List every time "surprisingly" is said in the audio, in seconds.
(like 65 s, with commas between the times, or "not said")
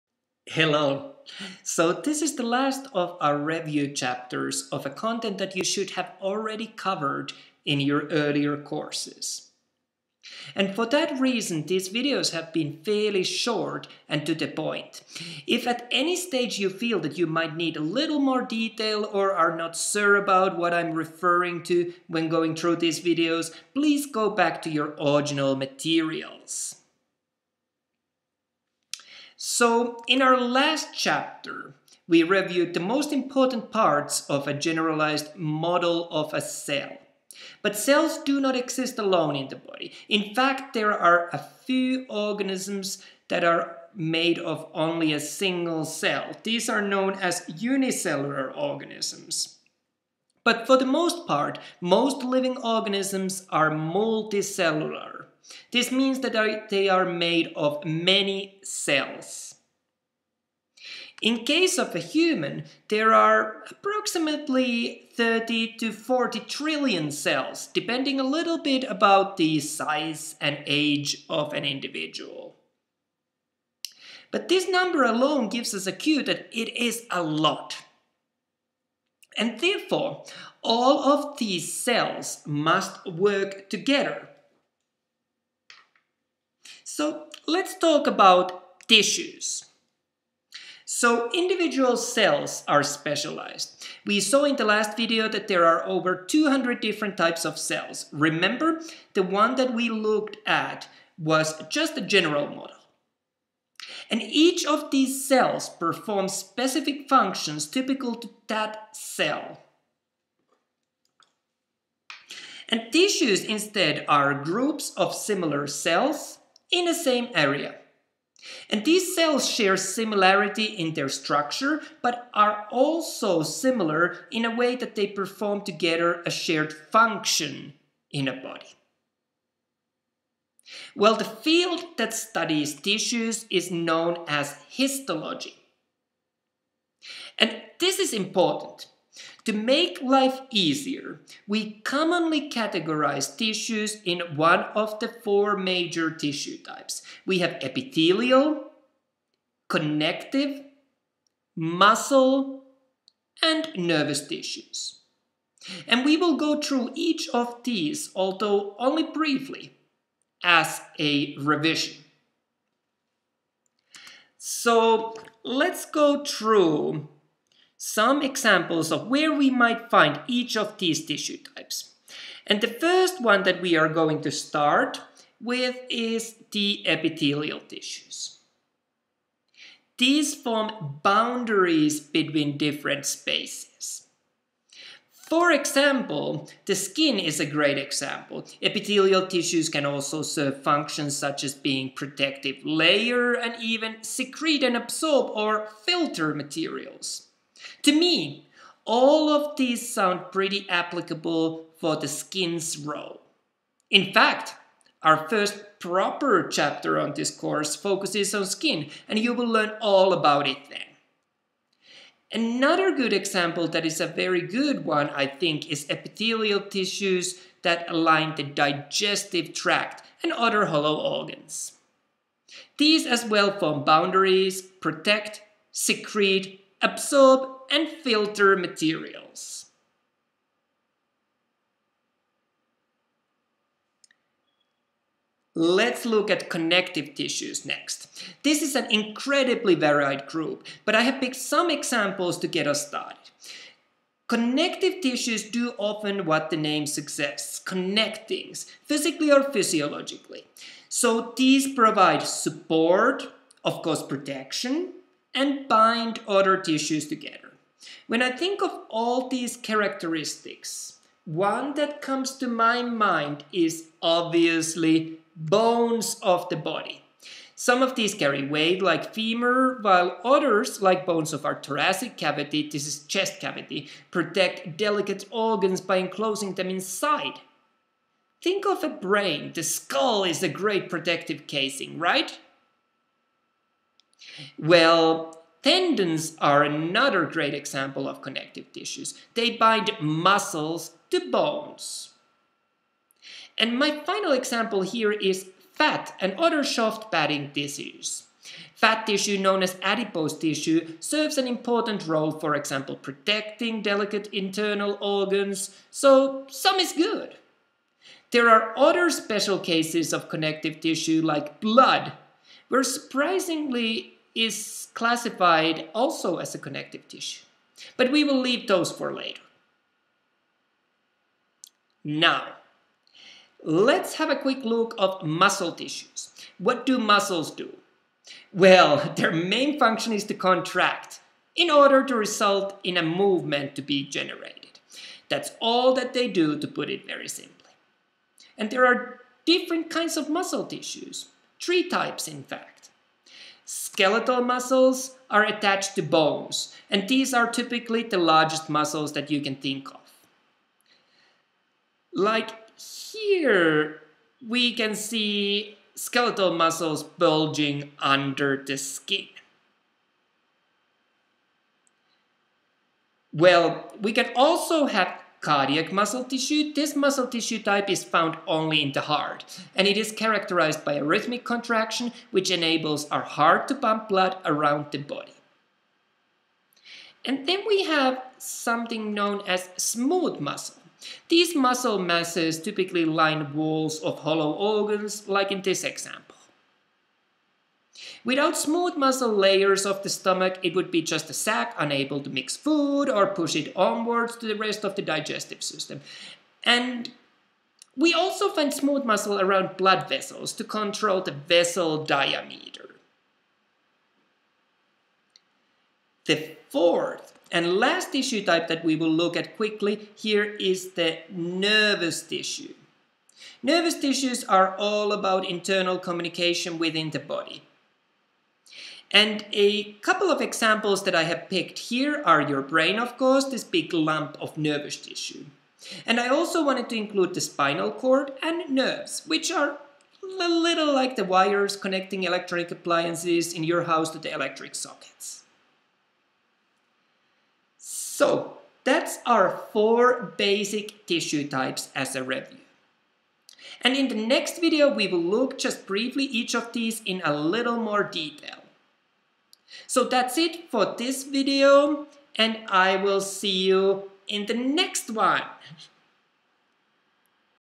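312 s.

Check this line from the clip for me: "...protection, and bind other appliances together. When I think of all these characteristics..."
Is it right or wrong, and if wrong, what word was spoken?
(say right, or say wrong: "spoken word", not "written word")
wrong: "tissues", not "appliances".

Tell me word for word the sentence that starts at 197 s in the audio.
To me, all of these sound pretty applicable for the skins role.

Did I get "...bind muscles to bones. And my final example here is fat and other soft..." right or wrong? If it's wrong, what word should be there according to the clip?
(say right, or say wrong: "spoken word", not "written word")
right.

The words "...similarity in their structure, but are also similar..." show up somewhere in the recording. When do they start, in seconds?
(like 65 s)
119 s.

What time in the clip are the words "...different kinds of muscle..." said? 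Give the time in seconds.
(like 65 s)
339 s.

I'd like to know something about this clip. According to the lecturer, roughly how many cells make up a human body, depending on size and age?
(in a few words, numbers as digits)
30 to 40 trillion.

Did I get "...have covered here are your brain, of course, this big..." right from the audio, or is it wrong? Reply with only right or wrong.
wrong.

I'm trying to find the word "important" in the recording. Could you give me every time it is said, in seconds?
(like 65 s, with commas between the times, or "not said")
33 s, 138 s, 301 s.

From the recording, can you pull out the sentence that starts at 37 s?
But cells do not exist alone in the body.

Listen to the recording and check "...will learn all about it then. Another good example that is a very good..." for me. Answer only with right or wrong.
right.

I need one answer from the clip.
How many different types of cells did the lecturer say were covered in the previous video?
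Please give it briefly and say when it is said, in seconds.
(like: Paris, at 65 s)
over 200, at 95 s.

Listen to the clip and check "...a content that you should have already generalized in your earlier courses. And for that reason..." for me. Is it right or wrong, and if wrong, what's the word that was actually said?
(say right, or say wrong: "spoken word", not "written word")
wrong: "covered", not "generalized".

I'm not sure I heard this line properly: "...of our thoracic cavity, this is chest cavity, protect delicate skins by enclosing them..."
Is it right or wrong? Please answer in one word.
wrong.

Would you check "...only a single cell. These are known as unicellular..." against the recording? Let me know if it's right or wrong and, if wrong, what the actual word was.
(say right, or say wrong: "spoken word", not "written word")
right.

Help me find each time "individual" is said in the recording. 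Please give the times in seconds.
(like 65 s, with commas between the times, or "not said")
71 s, 91 s.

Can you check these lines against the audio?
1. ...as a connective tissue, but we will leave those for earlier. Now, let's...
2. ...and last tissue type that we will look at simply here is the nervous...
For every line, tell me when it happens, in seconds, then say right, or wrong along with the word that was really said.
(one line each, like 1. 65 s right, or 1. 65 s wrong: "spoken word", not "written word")
1. 316 s wrong: "later", not "earlier"
2. 407 s wrong: "quickly", not "simply".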